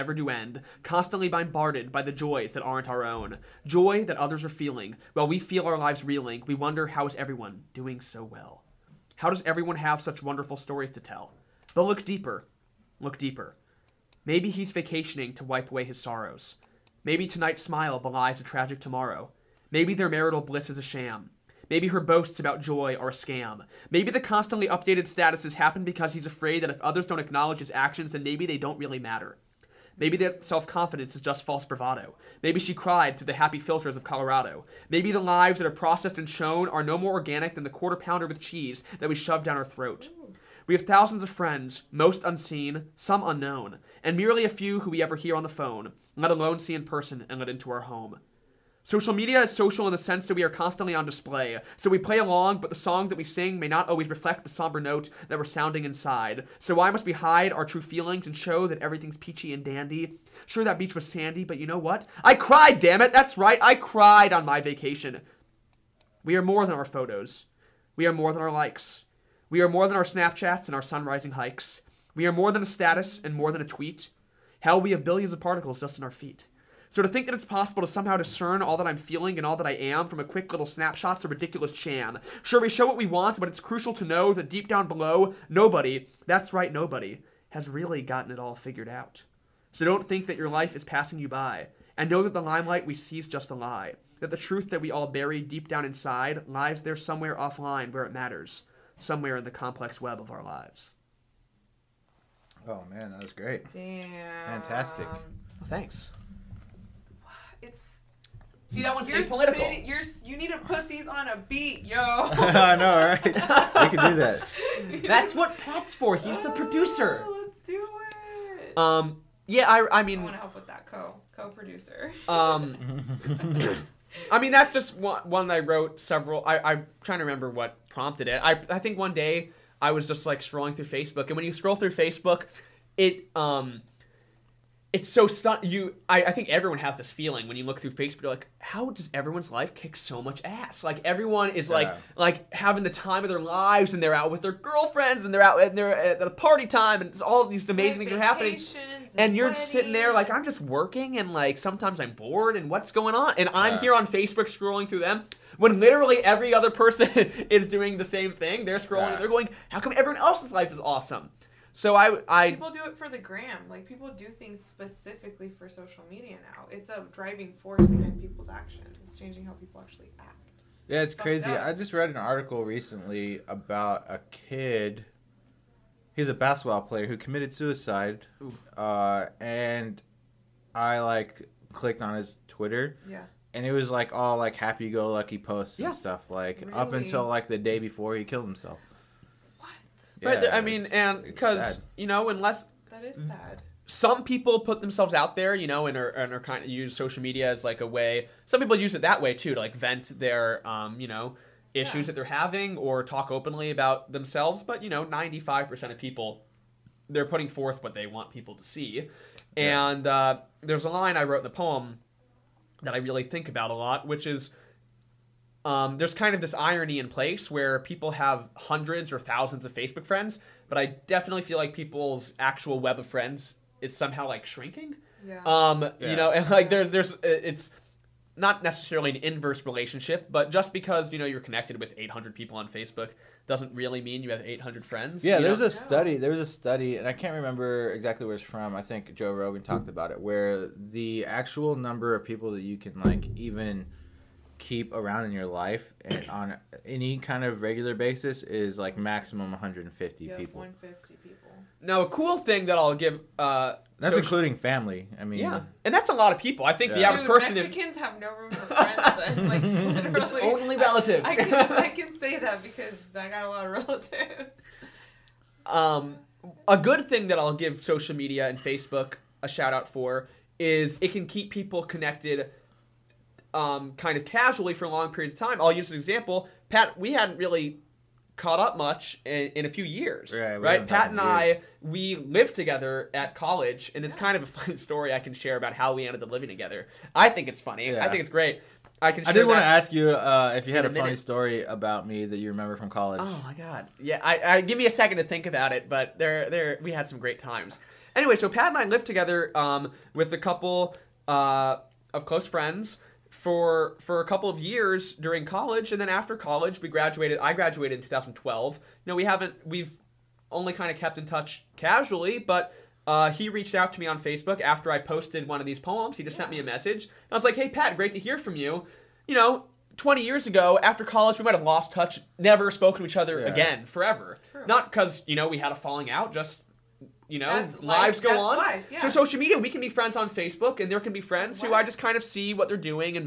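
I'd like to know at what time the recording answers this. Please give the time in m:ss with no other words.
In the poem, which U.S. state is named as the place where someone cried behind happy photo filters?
0:34.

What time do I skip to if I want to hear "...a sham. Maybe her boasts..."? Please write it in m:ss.
0:20.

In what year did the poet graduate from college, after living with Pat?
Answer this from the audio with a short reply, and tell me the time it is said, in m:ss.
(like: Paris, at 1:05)
2012, at 5:08.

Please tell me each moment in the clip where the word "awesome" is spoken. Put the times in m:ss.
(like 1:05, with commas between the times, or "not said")
2:40.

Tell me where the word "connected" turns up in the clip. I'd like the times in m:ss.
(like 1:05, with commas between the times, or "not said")
3:51, 4:31.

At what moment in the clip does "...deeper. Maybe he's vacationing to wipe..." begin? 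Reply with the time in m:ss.
0:13.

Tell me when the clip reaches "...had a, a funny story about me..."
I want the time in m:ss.
4:50.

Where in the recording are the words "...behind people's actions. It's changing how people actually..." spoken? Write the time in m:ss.
2:47.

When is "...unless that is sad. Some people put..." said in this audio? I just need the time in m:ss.
3:12.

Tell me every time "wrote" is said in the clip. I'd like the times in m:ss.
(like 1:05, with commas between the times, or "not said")
2:05, 3:31.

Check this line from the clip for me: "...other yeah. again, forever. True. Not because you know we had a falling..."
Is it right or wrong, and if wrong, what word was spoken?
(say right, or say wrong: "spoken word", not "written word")
right.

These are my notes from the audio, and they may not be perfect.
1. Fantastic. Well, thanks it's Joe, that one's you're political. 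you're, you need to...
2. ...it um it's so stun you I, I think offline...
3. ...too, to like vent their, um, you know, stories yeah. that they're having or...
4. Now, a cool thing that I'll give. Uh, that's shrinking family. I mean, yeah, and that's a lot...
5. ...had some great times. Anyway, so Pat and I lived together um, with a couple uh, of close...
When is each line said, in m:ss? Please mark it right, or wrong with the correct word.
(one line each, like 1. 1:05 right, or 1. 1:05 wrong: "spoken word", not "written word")
1. 1:44 wrong: "See", not "Joe"
2. 2:12 wrong: "everyone", not "offline"
3. 3:19 wrong: "issues", not "stories"
4. 4:11 wrong: "including", not "shrinking"
5. 4:56 right.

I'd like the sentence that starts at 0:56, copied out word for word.
So why must we hide our true feelings and show that everything's peachy and dandy?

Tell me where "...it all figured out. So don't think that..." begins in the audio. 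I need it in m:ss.
1:28.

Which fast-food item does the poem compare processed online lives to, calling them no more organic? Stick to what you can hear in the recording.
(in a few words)
quarter pounder with cheese.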